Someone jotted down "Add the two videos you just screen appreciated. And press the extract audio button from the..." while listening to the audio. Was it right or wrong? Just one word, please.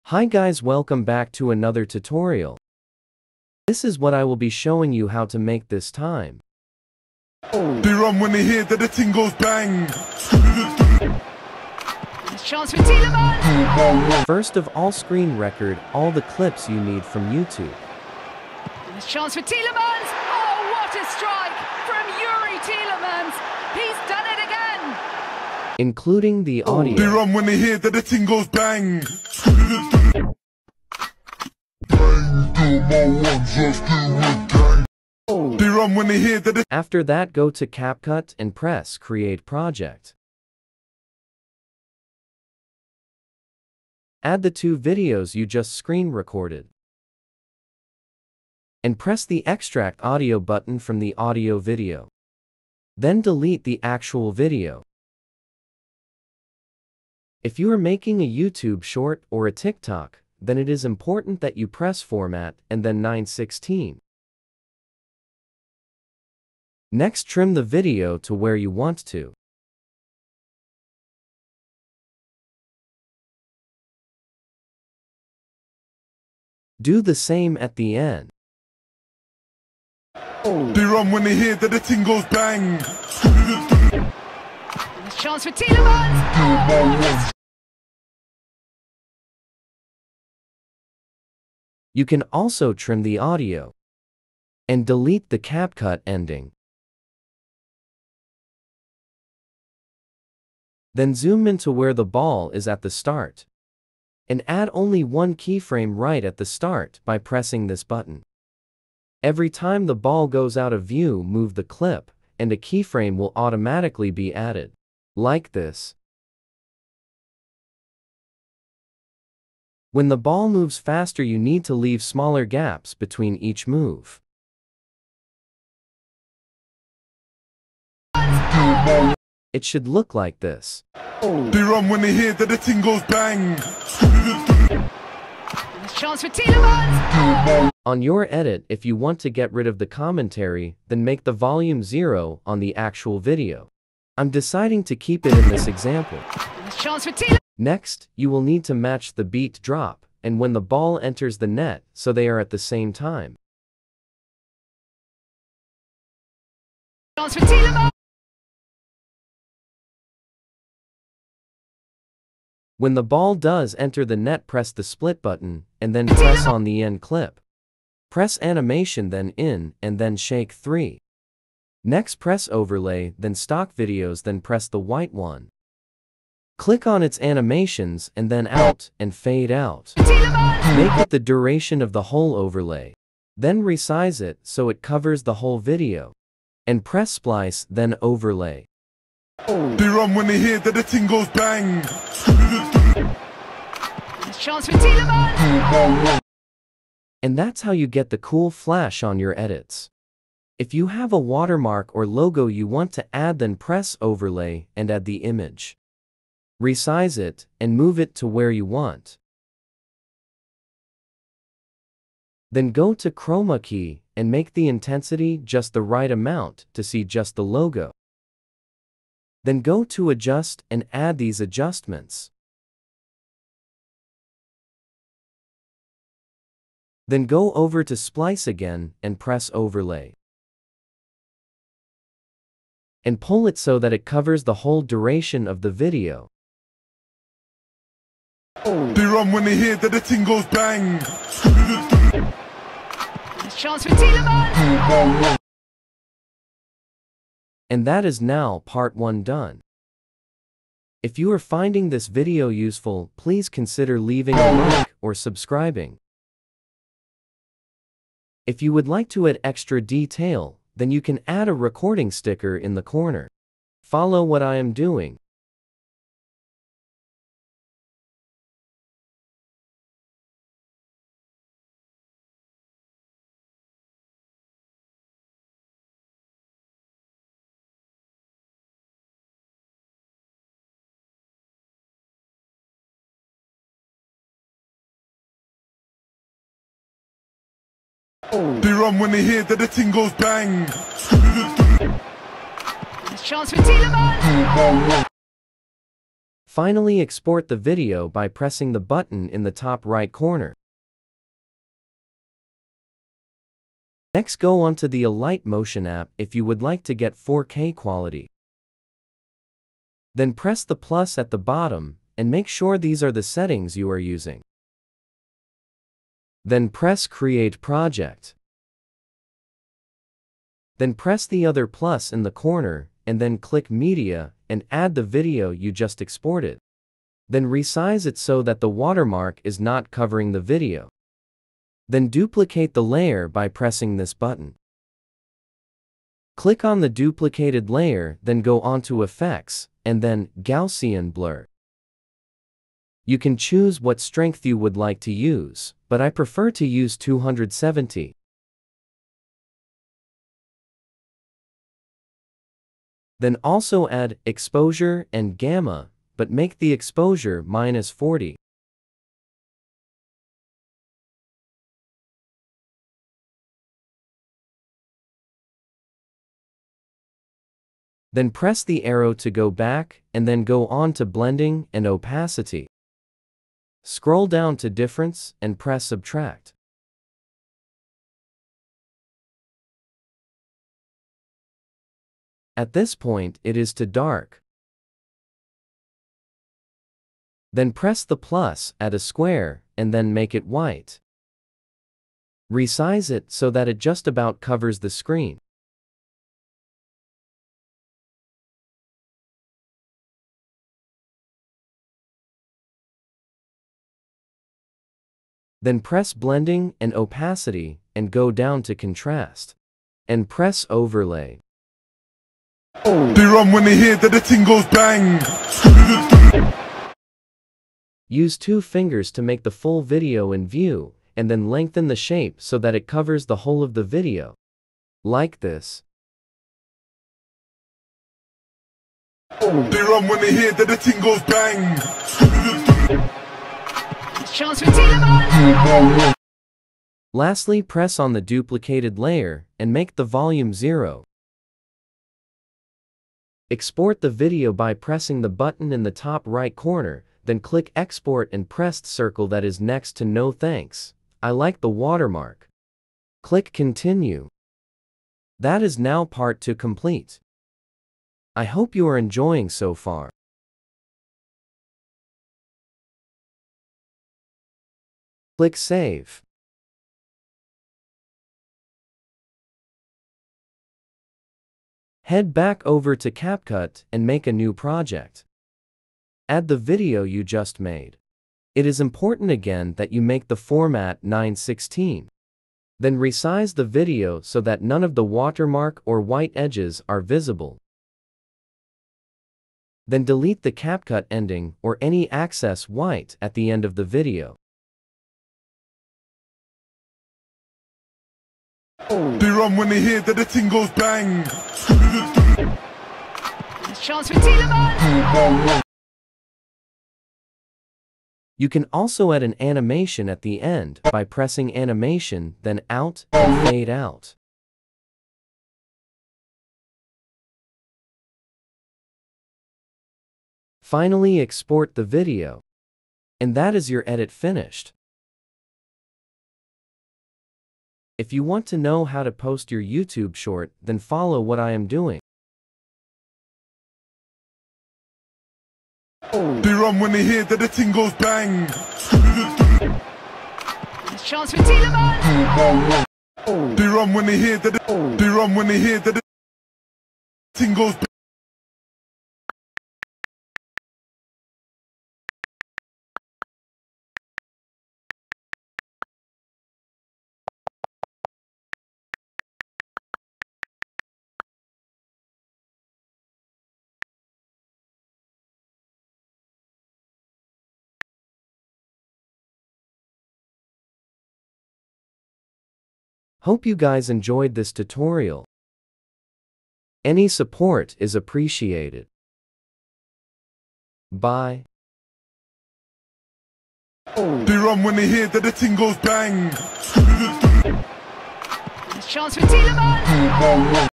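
wrong.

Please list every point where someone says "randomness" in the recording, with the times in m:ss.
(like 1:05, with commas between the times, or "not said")
not said.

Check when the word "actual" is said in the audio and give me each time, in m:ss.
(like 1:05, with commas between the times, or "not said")
0:53, 2:22.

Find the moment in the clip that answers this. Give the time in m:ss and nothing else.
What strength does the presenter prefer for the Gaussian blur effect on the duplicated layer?
5:46.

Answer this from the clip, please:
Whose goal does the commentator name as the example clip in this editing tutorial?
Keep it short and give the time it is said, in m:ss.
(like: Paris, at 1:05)
Youri Tielemans, at 0:22.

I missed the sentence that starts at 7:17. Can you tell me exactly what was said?
Lastly, press on the duplicated layer and make the volume 0.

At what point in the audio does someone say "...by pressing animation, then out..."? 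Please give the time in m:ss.
8:30.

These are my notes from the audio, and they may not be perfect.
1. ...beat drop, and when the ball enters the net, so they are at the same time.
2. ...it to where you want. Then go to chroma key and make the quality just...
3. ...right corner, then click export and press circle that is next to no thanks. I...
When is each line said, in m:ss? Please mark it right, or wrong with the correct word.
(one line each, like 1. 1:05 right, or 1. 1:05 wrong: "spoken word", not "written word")
1. 2:29 right
2. 3:27 wrong: "intensity", not "quality"
3. 7:26 right.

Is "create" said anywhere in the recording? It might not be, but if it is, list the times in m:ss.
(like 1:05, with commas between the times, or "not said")
0:38, 5:17.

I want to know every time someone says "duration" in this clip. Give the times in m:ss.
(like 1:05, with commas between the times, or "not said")
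3:01, 3:54.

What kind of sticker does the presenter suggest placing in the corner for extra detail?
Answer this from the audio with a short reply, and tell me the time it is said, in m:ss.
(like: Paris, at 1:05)
recording sticker, at 4:21.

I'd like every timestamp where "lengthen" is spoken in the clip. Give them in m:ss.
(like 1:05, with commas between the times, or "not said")
7:01.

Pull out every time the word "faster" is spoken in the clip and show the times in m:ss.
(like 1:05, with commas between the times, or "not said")
2:00.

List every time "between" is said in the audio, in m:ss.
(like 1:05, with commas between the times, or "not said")
2:02.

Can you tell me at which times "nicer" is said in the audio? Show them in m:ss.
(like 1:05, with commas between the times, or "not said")
not said.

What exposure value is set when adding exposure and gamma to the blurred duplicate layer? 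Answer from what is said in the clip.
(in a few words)
-40.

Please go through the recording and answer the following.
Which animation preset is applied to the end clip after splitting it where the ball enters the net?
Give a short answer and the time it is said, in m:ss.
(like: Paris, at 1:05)
shake 3, at 2:50.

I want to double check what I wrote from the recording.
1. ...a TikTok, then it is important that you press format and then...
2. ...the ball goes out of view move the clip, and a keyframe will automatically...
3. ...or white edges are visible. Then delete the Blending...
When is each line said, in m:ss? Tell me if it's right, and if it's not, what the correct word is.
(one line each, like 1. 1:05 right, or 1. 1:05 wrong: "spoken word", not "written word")
1. 0:59 right
2. 1:49 right
3. 8:05 wrong: "CapCut", not "Blending".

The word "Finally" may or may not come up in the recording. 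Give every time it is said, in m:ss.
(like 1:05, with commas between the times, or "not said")
4:56, 8:40.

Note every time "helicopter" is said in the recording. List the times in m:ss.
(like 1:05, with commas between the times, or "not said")
not said.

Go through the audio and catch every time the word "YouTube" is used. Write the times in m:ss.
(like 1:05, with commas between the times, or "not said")
0:17, 0:58, 8:49.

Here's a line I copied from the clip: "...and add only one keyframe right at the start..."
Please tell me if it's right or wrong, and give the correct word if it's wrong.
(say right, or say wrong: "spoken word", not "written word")
right.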